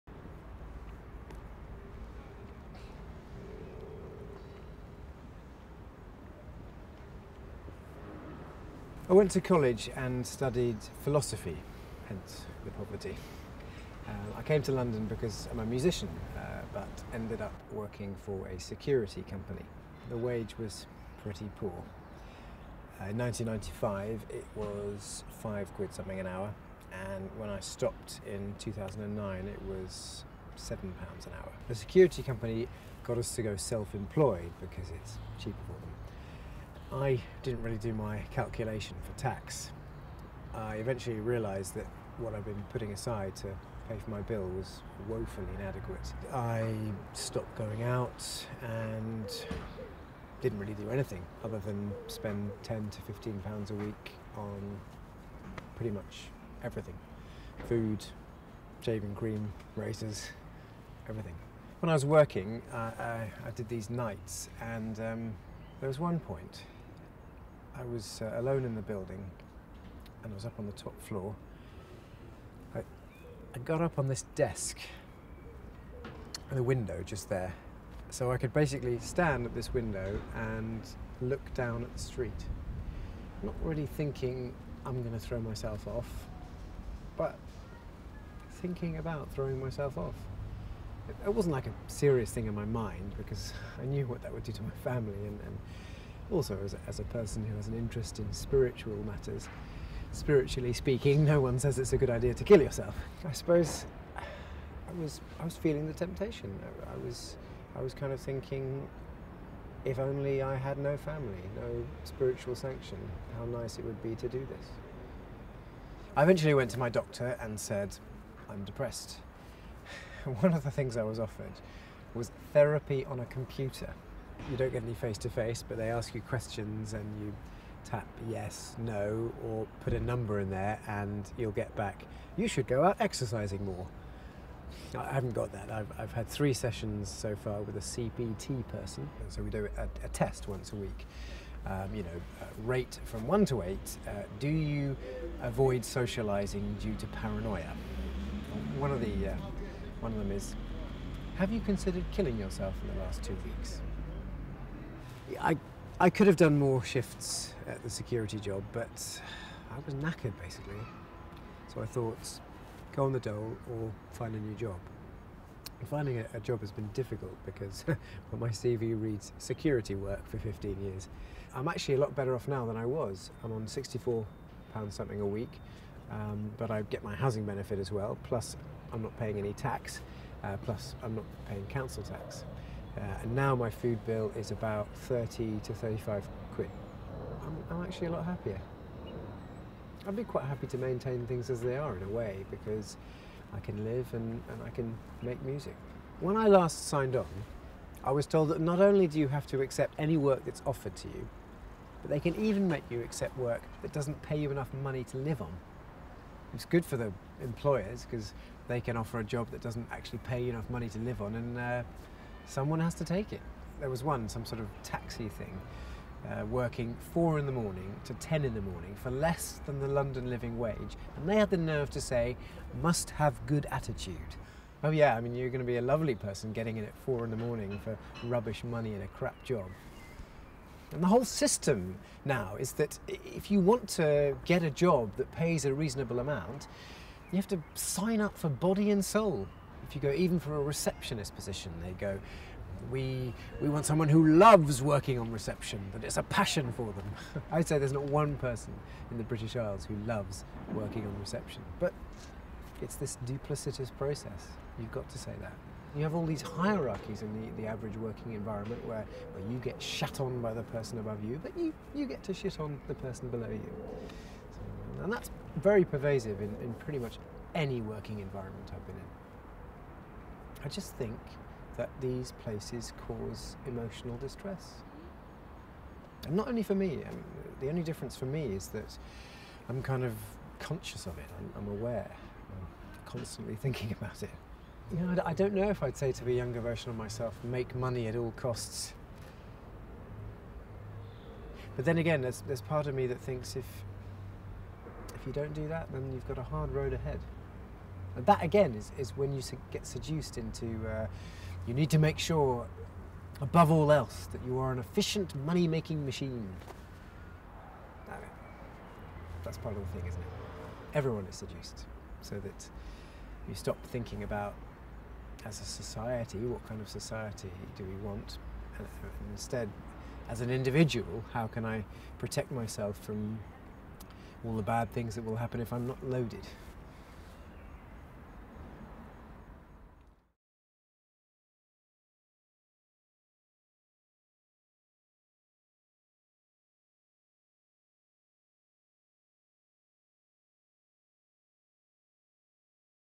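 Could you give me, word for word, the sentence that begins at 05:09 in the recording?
That's part of the thing, isn't it?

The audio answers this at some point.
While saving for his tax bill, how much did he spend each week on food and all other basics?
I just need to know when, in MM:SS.
00:52.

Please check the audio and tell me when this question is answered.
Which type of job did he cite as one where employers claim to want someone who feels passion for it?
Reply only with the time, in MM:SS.
04:00.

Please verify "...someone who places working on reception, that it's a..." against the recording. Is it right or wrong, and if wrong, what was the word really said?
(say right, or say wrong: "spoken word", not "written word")
wrong: "loves", not "places".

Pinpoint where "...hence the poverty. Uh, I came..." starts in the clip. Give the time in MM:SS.
00:12.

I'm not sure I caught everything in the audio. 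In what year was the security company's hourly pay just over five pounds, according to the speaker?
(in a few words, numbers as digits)
1995.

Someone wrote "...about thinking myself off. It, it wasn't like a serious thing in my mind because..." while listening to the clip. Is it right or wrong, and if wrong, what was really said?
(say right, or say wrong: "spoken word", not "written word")
wrong: "throwing", not "thinking".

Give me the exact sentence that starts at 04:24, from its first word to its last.
So, and that's very pervasive in, in pretty much any working environment I've been in.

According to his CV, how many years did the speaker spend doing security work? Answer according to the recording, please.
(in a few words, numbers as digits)
15 years.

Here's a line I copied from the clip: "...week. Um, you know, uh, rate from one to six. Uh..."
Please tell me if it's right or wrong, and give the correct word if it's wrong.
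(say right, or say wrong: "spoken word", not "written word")
wrong: "eight", not "six".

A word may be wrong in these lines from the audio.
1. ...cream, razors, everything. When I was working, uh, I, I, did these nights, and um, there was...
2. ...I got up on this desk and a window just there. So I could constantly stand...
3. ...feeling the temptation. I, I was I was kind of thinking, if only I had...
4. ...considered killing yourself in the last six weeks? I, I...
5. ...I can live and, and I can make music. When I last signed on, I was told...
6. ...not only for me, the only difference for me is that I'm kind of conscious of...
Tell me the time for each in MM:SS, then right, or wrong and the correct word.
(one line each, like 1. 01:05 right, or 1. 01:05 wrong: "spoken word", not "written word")
1. 00:59 right
2. 01:13 wrong: "basically", not "constantly"
3. 01:45 right
4. 02:31 wrong: "two", not "six"
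5. 03:13 right
6. 04:36 right.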